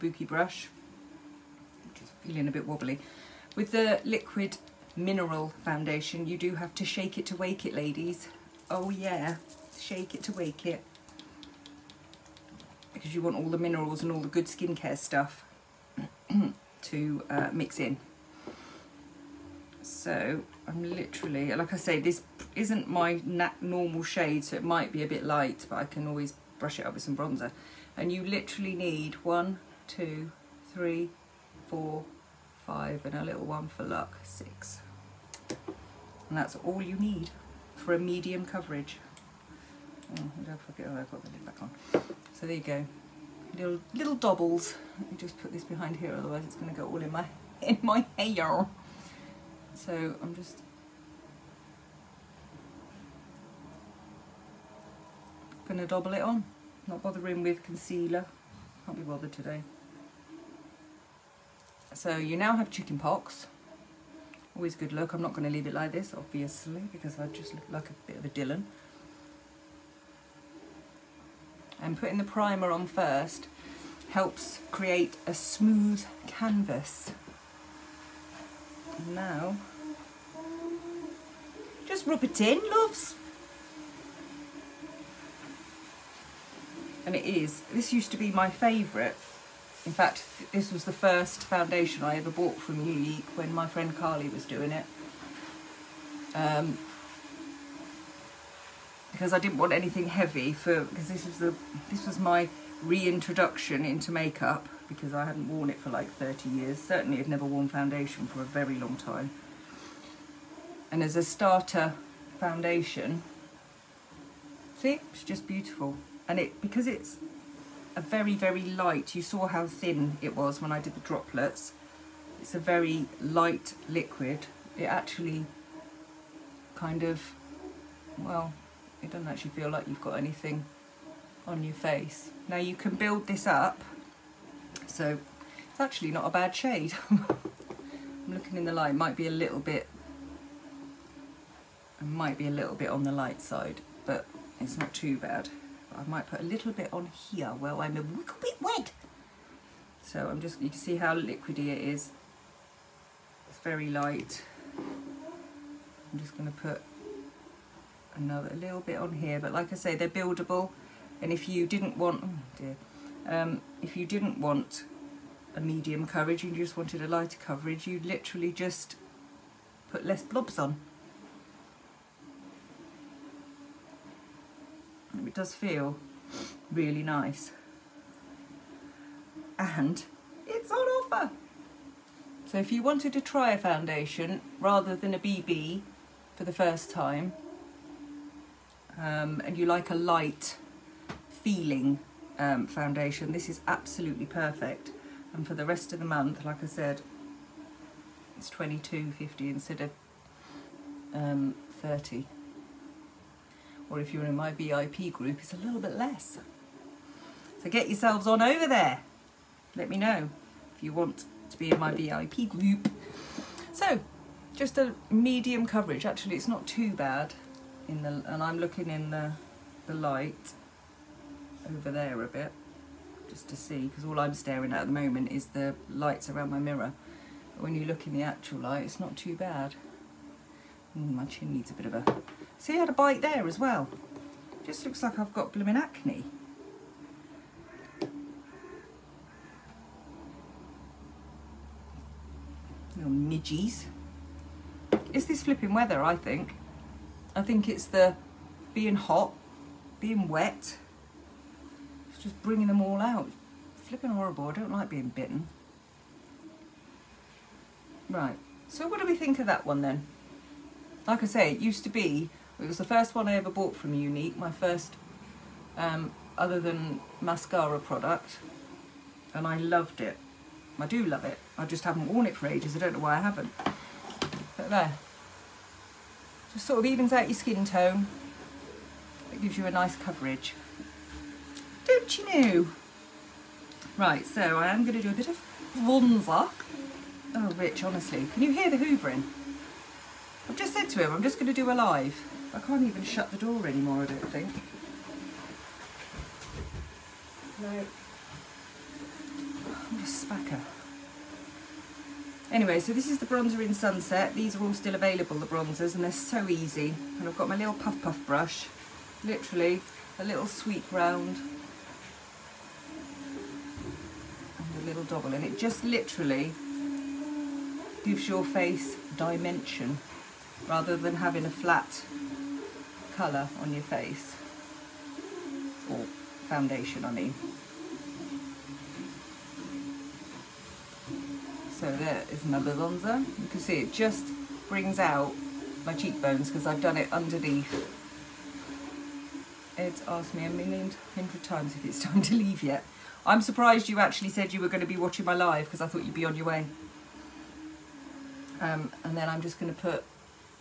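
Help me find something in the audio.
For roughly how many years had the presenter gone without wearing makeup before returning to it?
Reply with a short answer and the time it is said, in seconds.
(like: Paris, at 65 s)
30, at 106 s.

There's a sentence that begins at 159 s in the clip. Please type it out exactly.
But like I say, they're buildable.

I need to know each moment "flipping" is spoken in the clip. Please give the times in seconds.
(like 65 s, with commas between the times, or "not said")
245 s, 253 s.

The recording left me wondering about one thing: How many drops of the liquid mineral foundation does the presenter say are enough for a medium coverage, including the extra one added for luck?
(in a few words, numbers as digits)
6.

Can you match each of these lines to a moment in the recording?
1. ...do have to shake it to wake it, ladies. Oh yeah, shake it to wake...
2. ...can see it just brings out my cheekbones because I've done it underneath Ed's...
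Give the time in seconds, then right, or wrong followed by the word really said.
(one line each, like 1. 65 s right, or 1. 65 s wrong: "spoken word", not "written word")
1. 6 s right
2. 333 s right.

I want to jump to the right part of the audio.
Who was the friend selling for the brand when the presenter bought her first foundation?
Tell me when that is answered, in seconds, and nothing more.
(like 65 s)
93 s.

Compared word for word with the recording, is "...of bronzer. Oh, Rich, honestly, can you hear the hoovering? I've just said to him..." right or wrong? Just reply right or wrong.
right.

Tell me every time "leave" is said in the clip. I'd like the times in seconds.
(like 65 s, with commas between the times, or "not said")
65 s, 342 s.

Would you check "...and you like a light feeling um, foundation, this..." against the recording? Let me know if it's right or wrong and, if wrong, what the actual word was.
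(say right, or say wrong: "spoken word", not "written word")
right.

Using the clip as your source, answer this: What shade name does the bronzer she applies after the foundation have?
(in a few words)
Sunset.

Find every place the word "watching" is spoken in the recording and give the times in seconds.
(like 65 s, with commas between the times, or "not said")
344 s.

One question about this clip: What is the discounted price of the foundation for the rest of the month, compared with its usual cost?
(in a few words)
22.50.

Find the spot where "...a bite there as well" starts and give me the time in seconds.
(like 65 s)
232 s.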